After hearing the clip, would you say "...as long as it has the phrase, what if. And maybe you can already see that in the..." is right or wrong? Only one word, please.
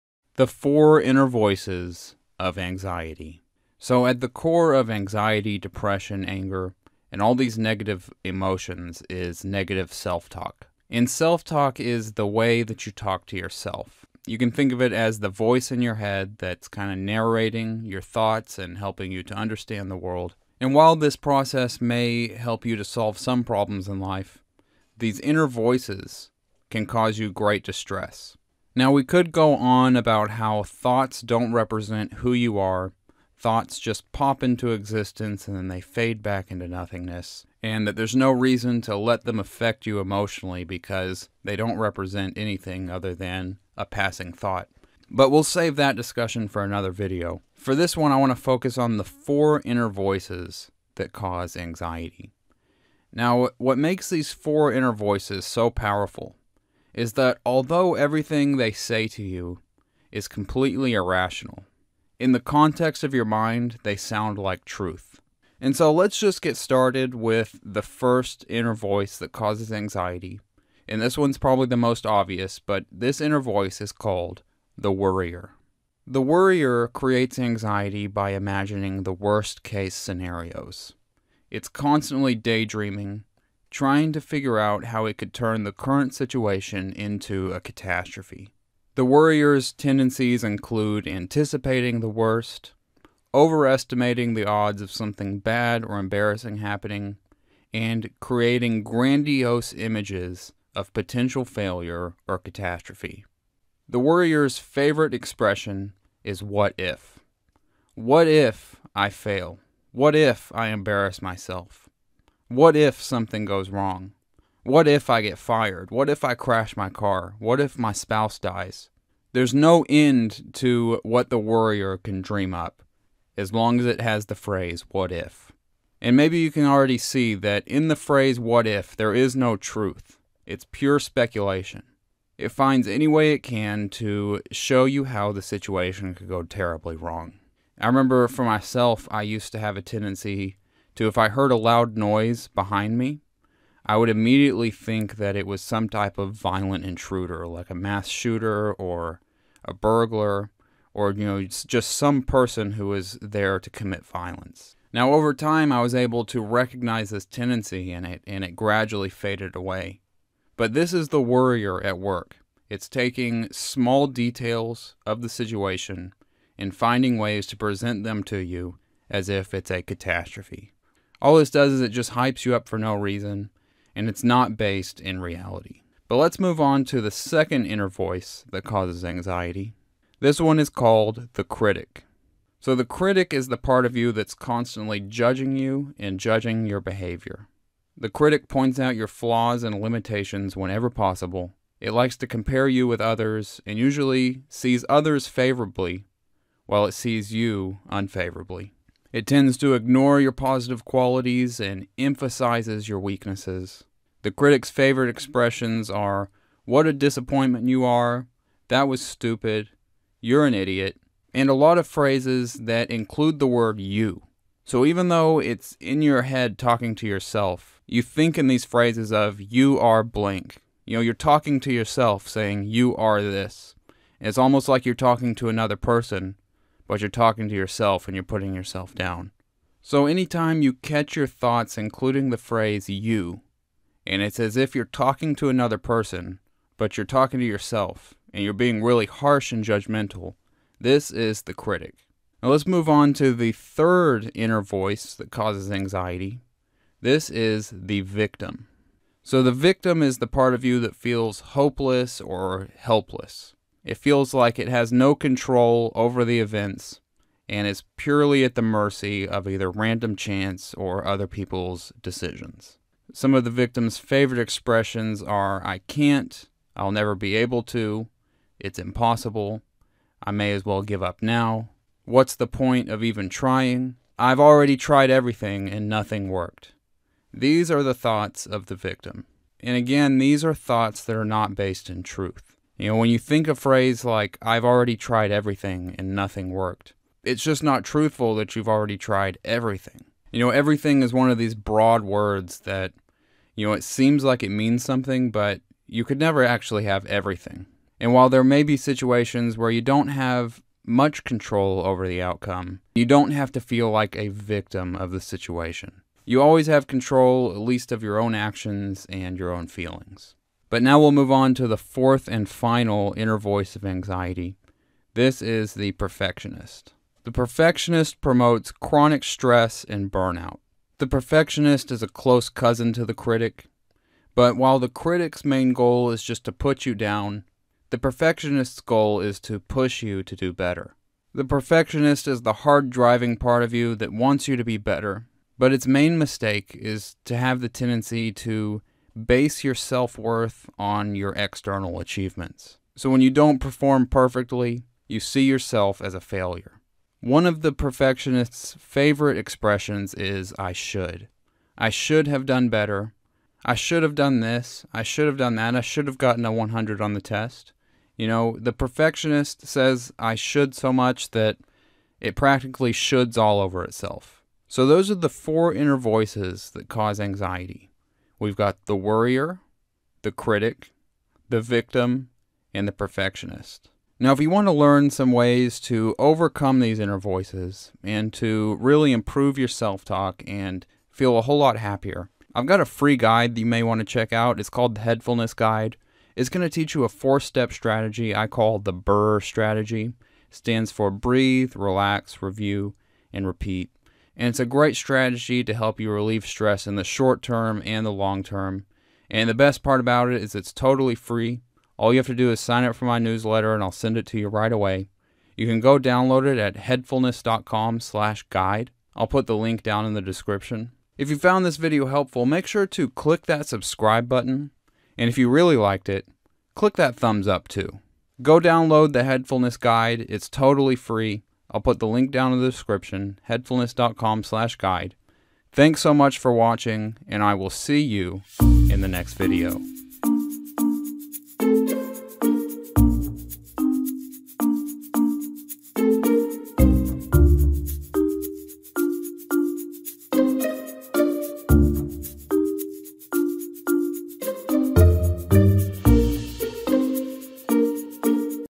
right.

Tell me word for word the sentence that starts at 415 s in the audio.
And if you really liked it, click that thumbs up too.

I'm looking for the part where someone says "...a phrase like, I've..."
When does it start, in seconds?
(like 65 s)
283 s.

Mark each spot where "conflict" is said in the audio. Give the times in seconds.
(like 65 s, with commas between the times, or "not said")
not said.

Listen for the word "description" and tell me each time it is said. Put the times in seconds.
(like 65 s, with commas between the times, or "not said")
410 s, 422 s.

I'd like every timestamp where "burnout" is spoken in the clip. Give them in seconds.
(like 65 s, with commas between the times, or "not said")
320 s.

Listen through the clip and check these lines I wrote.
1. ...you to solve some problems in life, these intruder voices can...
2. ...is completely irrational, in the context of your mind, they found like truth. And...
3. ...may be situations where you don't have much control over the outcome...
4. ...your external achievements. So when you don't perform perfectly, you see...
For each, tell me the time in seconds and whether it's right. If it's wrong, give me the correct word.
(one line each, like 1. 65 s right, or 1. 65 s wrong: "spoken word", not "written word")
1. 22 s wrong: "inner", not "intruder"
2. 60 s wrong: "sound", not "found"
3. 298 s right
4. 341 s right.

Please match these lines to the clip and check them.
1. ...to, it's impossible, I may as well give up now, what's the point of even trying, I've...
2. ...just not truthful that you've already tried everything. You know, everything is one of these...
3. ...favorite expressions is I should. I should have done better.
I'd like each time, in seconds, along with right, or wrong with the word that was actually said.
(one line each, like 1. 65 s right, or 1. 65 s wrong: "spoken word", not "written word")
1. 267 s right
2. 287 s right
3. 348 s right.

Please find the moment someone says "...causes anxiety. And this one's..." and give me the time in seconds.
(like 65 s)
69 s.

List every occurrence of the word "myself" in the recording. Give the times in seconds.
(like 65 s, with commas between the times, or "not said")
111 s, 138 s.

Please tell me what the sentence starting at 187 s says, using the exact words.
The critic points out your flaws and limitations whenever possible.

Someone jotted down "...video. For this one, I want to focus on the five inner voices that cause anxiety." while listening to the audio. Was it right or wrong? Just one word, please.
wrong.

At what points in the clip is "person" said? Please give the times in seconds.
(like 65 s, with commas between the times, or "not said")
152 s, 225 s, 235 s.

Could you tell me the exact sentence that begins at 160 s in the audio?
But this is the worrier at work.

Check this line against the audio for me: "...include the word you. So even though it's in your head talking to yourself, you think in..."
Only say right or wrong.
right.